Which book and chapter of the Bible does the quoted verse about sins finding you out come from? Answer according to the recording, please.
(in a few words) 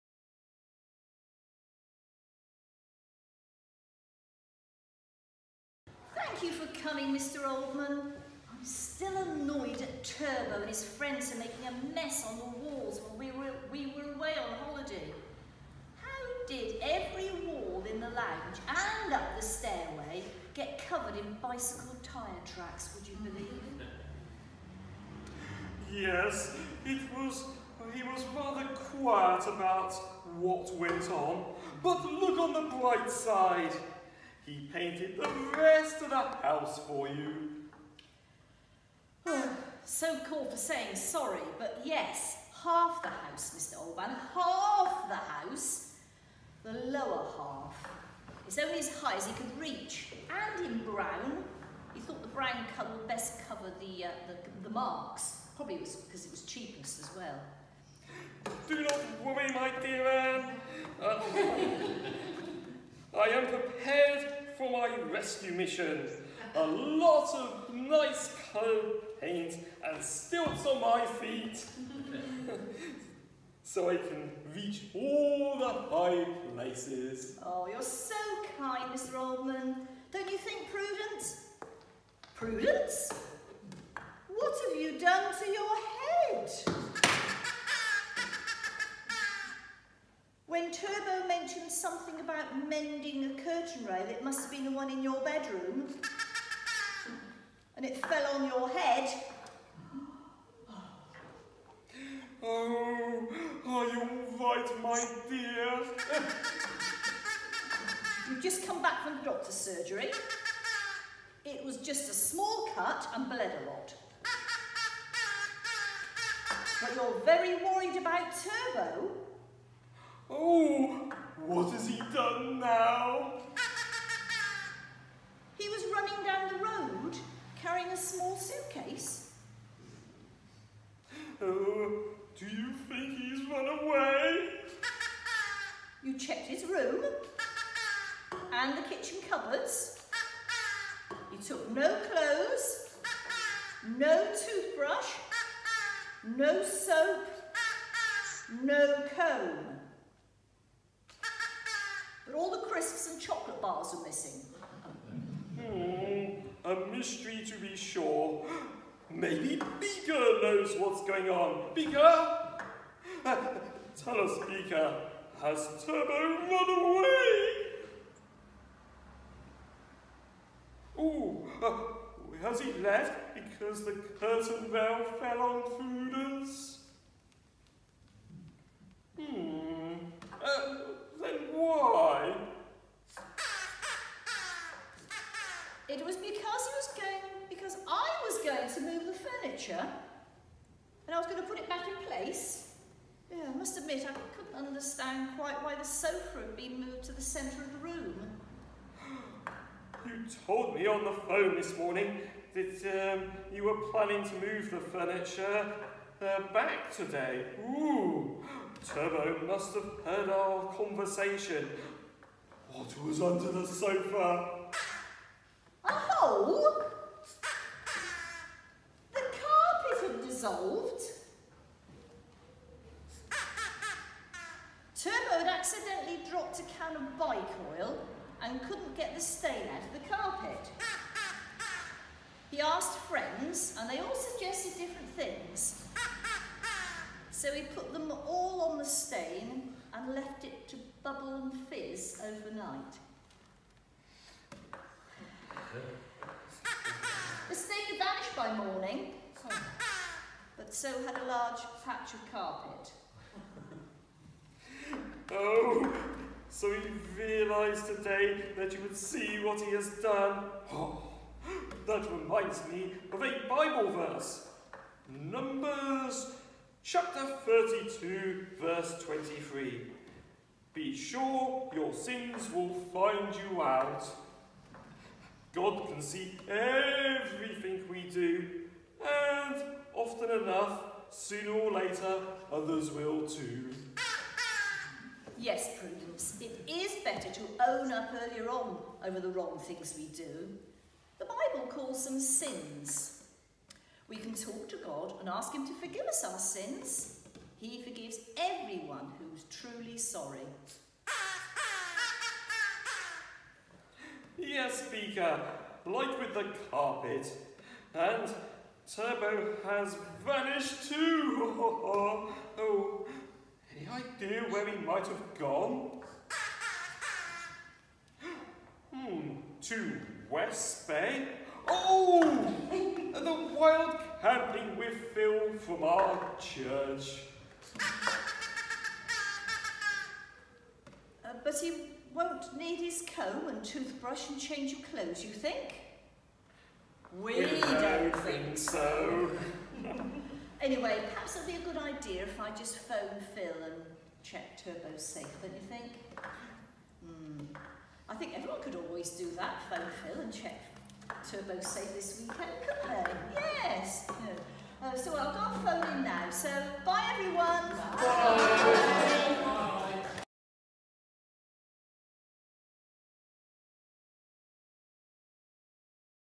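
Numbers chapter 32.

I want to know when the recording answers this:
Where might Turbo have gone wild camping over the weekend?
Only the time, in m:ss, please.
5:20.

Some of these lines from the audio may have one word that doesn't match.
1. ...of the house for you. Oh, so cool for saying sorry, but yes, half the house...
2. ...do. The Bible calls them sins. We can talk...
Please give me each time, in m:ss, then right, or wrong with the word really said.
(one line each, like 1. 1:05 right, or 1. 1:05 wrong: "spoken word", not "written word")
1. 0:36 right
2. 4:50 right.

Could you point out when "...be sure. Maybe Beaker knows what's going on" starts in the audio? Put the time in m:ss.
2:37.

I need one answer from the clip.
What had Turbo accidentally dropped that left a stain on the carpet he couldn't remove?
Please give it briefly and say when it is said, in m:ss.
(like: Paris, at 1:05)
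A can of bike oil, at 3:46.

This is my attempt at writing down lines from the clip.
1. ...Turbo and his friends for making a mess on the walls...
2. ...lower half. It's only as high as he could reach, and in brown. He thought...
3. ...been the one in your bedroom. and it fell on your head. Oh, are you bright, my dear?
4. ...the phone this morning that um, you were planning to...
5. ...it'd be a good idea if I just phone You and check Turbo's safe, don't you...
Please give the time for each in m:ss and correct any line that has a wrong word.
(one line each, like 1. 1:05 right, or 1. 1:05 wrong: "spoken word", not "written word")
1. 0:10 right
2. 0:46 right
3. 1:34 wrong: "alright", not "bright"
4. 3:21 right
5. 5:41 wrong: "Phil", not "You".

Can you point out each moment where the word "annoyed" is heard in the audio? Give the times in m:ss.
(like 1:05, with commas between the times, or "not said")
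0:09.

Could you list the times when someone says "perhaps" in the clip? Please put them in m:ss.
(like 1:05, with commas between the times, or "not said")
5:41.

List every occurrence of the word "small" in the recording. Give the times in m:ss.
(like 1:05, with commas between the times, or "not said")
1:52, 2:07.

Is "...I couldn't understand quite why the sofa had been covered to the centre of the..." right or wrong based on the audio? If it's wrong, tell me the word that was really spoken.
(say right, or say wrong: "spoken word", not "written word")
wrong: "moved", not "covered".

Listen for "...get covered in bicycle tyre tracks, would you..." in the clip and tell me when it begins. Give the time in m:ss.
0:20.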